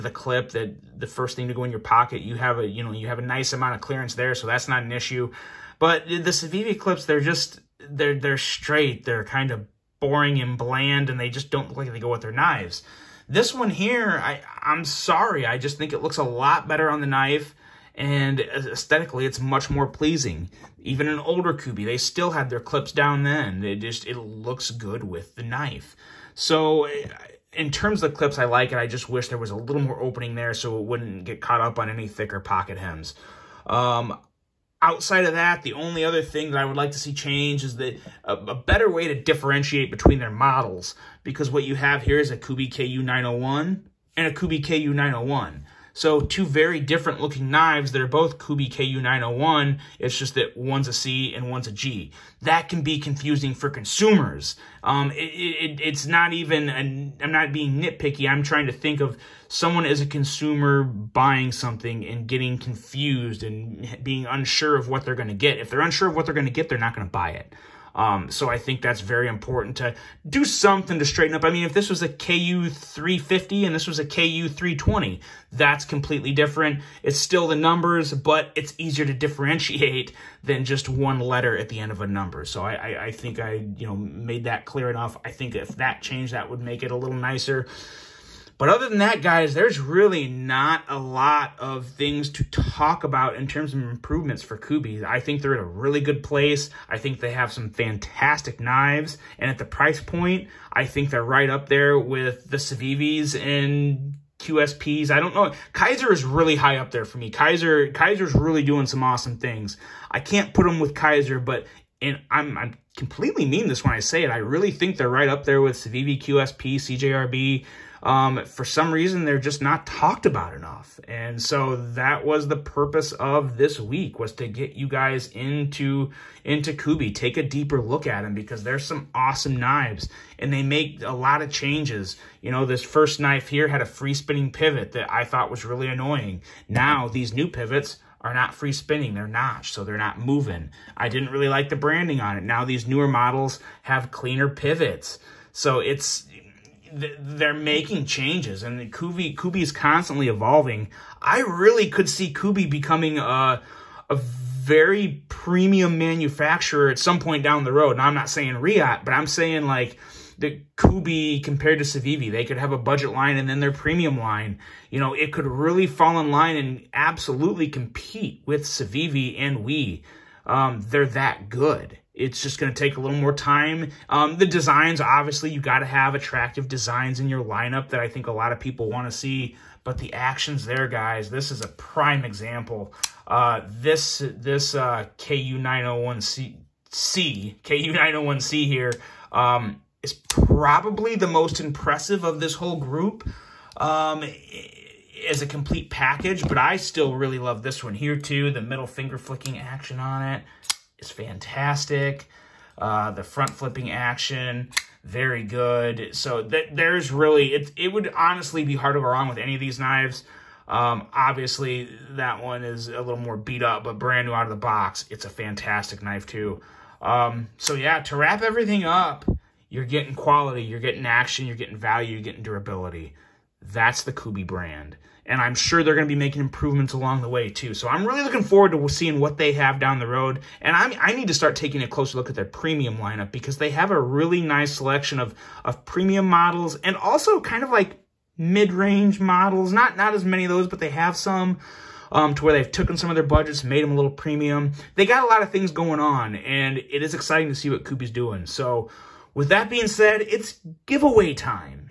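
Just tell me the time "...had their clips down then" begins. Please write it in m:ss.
0:22.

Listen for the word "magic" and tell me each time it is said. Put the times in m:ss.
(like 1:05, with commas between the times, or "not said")
not said.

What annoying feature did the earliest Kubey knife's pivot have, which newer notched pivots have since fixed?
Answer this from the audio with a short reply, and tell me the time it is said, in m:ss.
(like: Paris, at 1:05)
free spinning pivot, at 2:13.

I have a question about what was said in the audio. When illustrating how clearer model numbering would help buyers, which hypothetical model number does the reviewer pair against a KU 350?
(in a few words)
KU 320.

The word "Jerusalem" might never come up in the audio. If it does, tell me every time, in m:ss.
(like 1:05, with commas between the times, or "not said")
not said.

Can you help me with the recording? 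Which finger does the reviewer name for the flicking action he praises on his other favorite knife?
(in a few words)
middle finger.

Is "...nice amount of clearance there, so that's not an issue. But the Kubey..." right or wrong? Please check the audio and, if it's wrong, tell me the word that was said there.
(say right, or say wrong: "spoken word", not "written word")
wrong: "Civivi", not "Kubey".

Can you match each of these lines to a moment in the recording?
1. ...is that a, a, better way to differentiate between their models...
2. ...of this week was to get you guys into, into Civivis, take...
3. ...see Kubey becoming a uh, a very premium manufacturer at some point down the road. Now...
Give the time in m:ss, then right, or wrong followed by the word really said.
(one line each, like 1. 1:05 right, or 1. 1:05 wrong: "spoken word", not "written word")
1. 0:37 right
2. 2:03 wrong: "Kubey", not "Civivis"
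3. 2:32 right.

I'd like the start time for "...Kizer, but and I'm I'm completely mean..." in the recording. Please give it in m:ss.
1:50.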